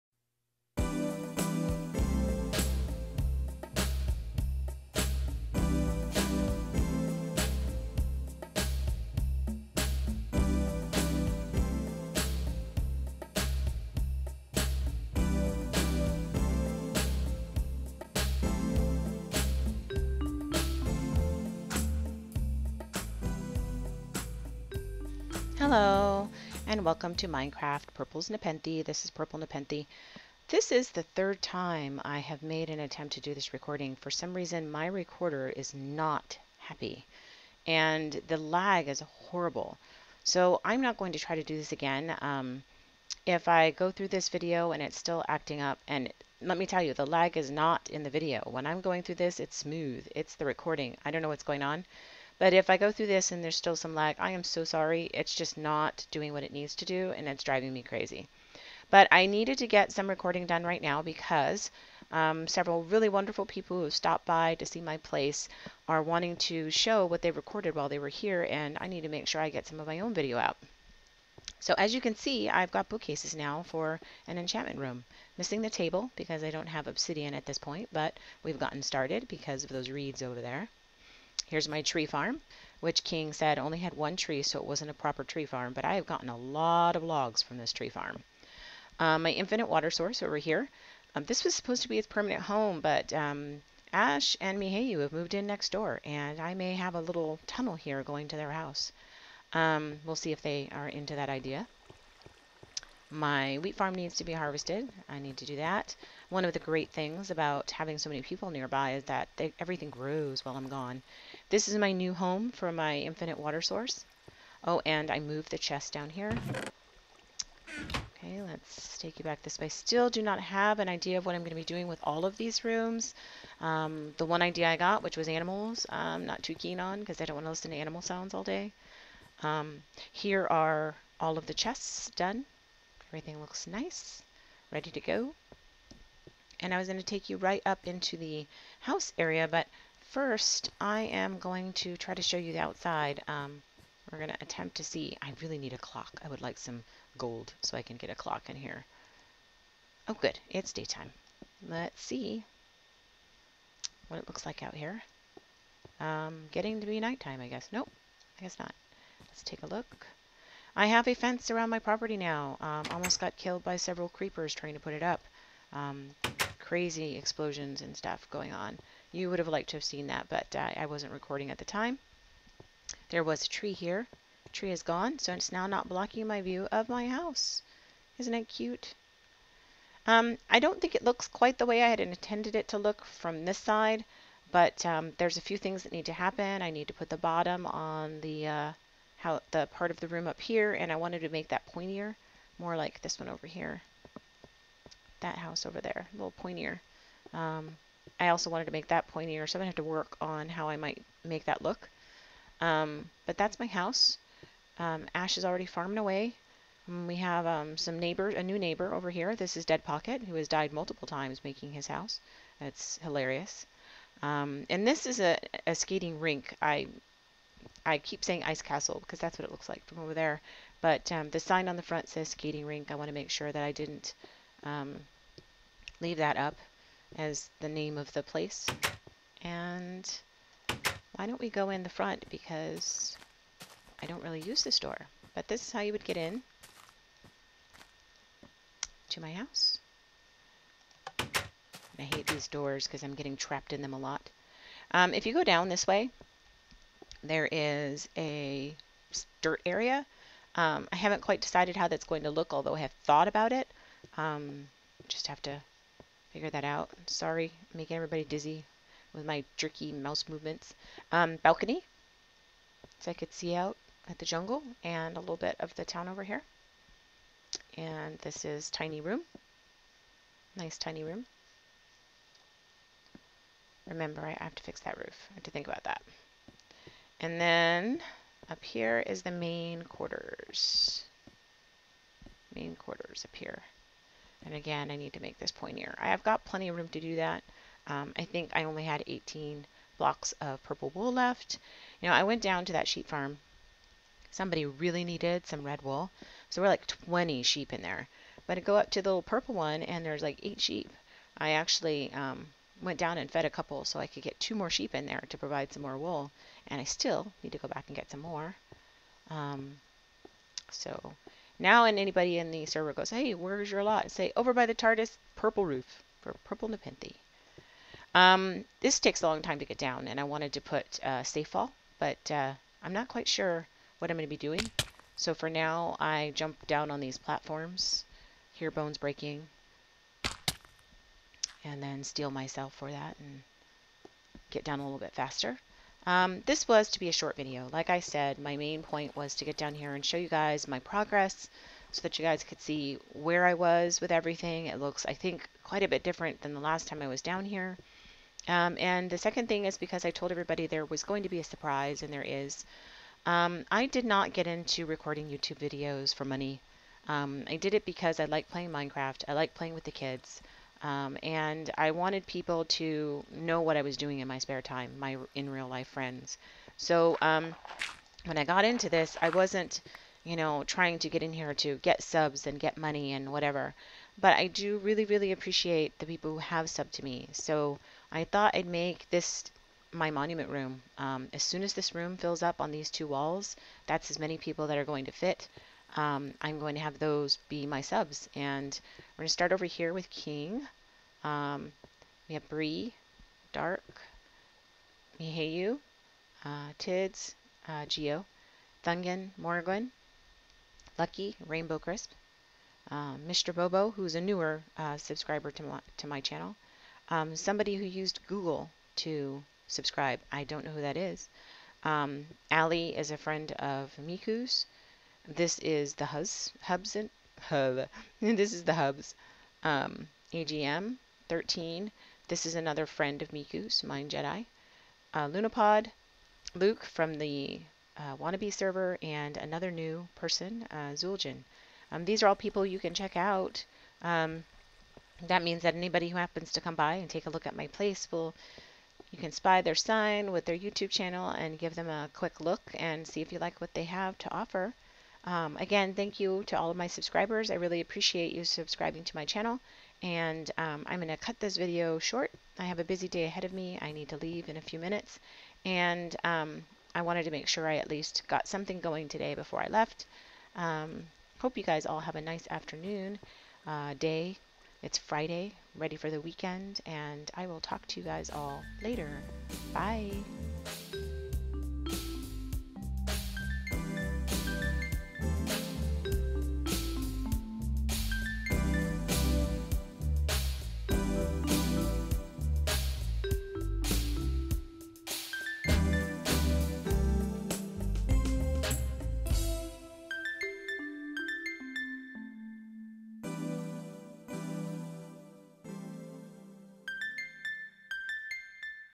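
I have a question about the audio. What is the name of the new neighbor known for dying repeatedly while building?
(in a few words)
Dead Pocket.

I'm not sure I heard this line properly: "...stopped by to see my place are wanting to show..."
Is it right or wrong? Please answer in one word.
right.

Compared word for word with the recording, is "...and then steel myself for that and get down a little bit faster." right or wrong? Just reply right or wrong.
right.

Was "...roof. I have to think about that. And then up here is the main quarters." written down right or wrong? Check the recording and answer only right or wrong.
right.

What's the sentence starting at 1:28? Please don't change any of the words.
Um, my infinite water source over here.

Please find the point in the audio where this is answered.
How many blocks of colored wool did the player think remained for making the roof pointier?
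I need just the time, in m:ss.
4:49.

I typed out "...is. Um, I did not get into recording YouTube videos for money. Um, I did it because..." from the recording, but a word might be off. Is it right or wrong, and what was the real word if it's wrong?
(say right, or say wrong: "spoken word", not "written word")
right.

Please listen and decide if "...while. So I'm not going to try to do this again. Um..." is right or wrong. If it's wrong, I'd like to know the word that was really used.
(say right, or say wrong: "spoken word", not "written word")
wrong: "horrible", not "while".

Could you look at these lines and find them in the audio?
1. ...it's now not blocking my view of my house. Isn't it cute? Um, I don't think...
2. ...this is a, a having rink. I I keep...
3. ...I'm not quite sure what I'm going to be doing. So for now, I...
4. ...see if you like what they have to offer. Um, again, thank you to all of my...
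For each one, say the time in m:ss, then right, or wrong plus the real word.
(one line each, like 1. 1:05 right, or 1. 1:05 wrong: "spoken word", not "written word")
1. 2:55 right
2. 3:34 wrong: "skating", not "having"
3. 5:22 right
4. 7:23 right.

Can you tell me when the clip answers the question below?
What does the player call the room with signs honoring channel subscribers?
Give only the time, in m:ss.
6:20.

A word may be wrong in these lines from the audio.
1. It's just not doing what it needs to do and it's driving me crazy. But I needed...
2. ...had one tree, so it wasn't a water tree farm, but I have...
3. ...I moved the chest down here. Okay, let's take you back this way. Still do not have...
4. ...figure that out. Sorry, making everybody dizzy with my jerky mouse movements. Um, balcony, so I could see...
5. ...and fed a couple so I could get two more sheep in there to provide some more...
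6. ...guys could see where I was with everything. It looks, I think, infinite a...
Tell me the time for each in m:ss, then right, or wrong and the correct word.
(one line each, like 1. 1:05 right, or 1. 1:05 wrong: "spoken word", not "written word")
1. 0:55 right
2. 1:23 wrong: "proper", not "water"
3. 1:55 right
4. 4:16 right
5. 5:03 right
6. 5:42 wrong: "quite", not "infinite".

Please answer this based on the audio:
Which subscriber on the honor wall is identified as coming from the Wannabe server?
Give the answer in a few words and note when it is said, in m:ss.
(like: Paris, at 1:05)
Luke, at 7:06.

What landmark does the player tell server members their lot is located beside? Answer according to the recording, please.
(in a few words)
the TARDIS.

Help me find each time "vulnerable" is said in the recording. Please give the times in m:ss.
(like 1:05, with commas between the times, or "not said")
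not said.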